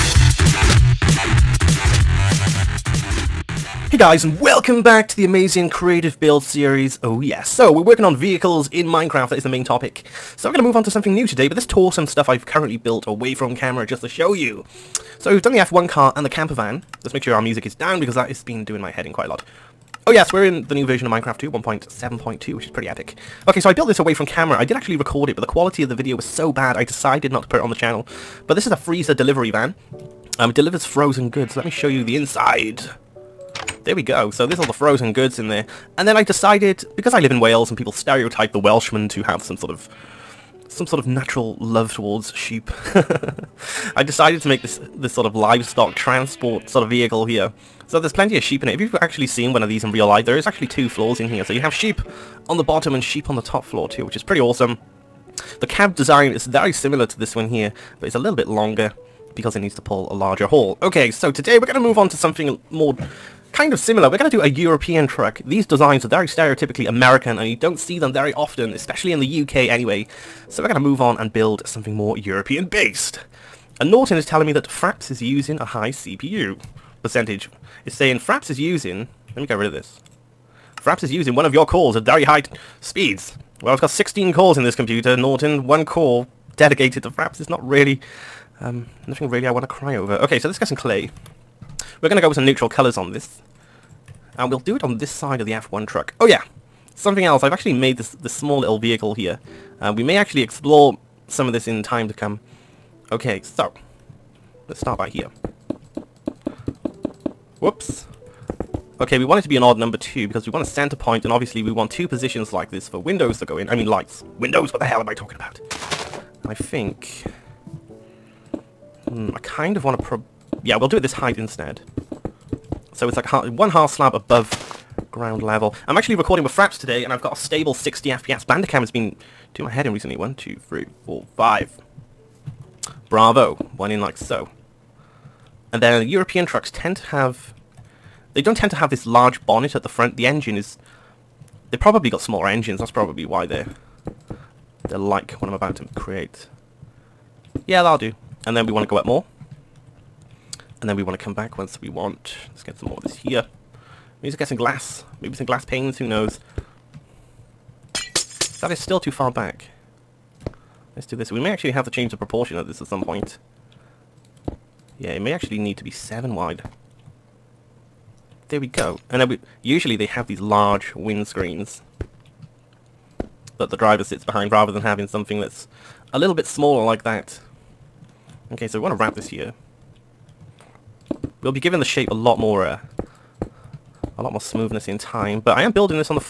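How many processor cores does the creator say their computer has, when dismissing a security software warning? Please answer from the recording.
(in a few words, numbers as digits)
16.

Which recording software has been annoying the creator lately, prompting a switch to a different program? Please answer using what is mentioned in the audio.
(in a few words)
Bandicam.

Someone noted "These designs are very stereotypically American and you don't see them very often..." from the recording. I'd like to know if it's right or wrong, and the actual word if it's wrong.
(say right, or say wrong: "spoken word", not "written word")
right.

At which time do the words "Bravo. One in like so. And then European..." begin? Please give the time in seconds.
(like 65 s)
133 s.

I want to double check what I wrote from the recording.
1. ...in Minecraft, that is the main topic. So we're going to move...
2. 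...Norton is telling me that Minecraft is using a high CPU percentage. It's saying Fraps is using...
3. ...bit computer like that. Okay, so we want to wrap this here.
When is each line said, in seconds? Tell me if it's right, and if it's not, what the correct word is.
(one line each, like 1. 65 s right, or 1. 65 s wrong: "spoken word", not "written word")
1. 8 s right
2. 73 s wrong: "Fraps", not "Minecraft"
3. 176 s wrong: "smaller", not "computer".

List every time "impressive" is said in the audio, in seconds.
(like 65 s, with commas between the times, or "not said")
not said.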